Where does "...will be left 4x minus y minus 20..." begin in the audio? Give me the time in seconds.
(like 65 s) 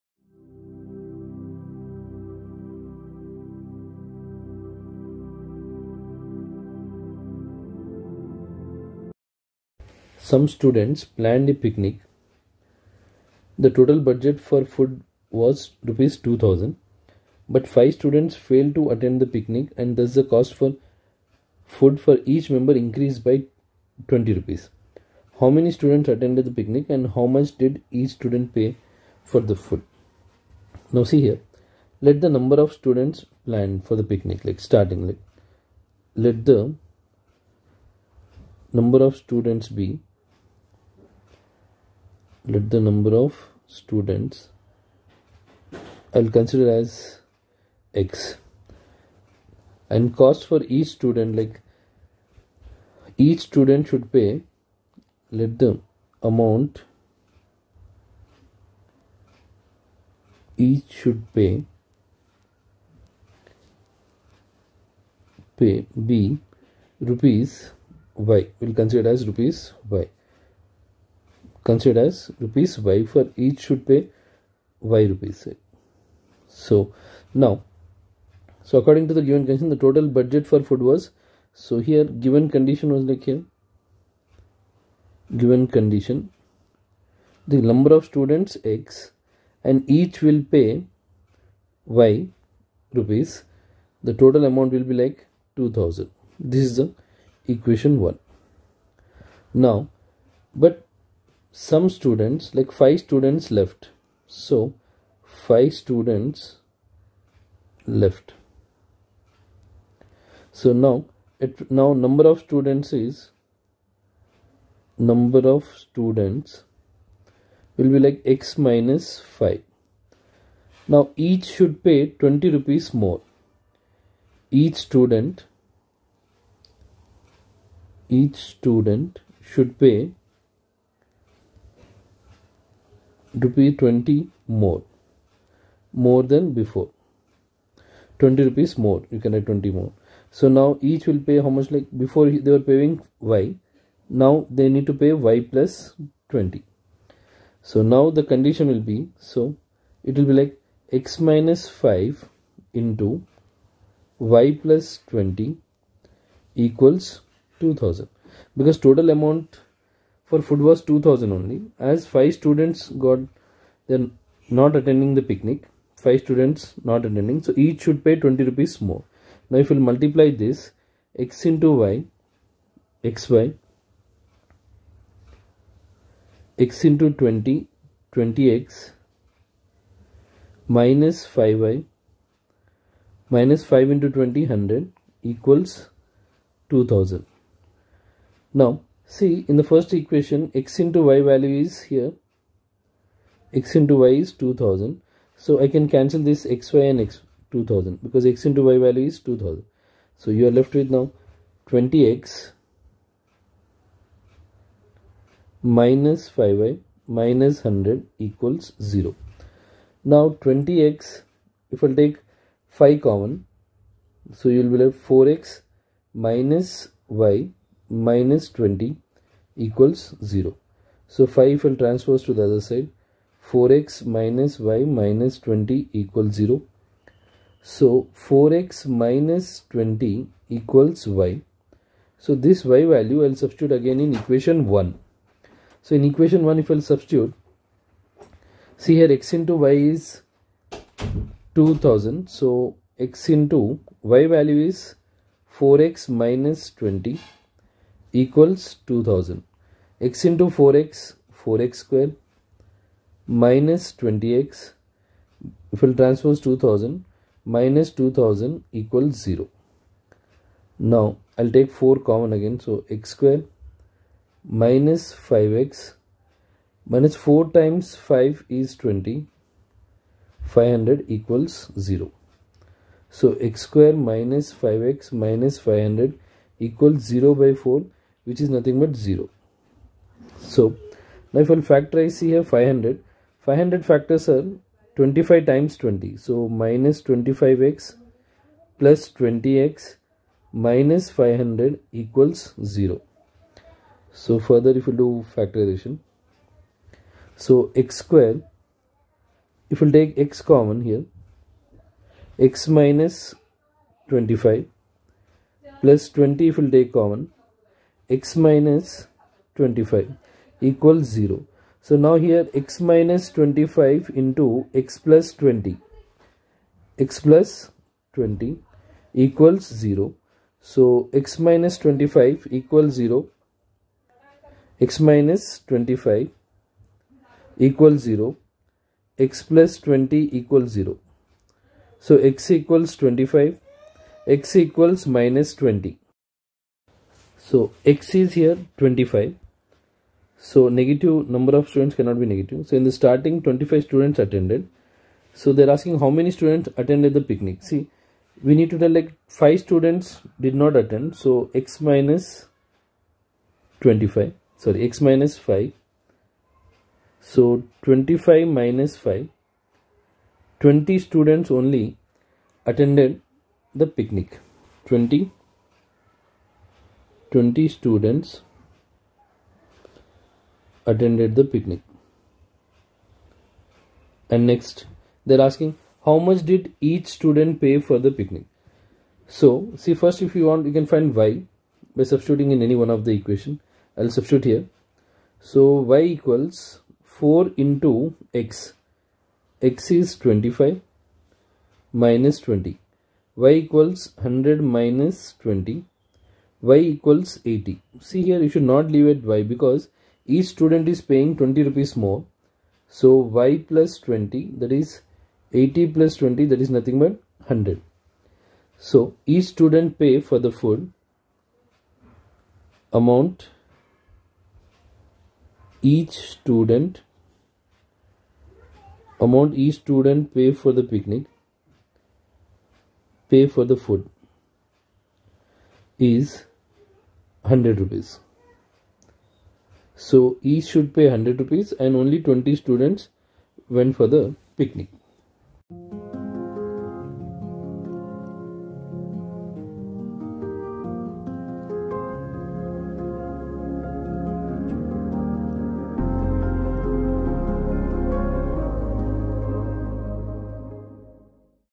214 s.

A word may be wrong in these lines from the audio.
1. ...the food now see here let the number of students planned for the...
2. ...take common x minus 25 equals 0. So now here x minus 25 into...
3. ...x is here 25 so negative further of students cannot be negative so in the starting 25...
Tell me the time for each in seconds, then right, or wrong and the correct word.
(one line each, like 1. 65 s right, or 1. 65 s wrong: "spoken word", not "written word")
1. 29 s right
2. 306 s right
3. 337 s wrong: "number", not "further".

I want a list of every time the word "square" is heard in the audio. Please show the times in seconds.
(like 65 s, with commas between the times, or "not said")
251 s, 263 s, 273 s, 298 s.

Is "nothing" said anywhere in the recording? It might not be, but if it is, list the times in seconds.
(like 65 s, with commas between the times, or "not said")
278 s, 406 s.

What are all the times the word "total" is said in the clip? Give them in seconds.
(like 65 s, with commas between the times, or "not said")
13 s, 79 s, 94 s, 158 s.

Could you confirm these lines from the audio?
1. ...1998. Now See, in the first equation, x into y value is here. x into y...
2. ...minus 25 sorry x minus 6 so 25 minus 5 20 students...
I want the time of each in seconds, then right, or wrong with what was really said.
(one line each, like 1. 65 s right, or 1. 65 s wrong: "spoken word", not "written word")
1. 186 s wrong: "2000", not "1998"
2. 351 s wrong: "5", not "6".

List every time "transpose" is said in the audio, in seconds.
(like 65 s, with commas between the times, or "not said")
221 s, 255 s.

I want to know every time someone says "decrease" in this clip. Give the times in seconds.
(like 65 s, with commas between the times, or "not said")
not said.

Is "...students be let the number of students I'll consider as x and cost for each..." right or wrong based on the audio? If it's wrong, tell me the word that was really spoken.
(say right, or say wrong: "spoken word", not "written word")
right.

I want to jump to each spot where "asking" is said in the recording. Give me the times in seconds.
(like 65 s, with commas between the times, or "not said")
345 s, 375 s.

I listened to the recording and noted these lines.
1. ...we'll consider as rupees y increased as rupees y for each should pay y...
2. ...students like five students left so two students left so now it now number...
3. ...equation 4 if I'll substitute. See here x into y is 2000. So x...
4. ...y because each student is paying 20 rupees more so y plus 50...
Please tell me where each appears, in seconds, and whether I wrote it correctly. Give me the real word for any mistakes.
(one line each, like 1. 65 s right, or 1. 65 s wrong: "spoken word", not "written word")
1. 68 s wrong: "considered", not "increased"
2. 101 s wrong: "five", not "two"
3. 236 s wrong: "1", not "4"
4. 399 s wrong: "20", not "50".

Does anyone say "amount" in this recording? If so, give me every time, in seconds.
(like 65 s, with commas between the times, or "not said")
56 s, 94 s, 159 s, 413 s, 419 s.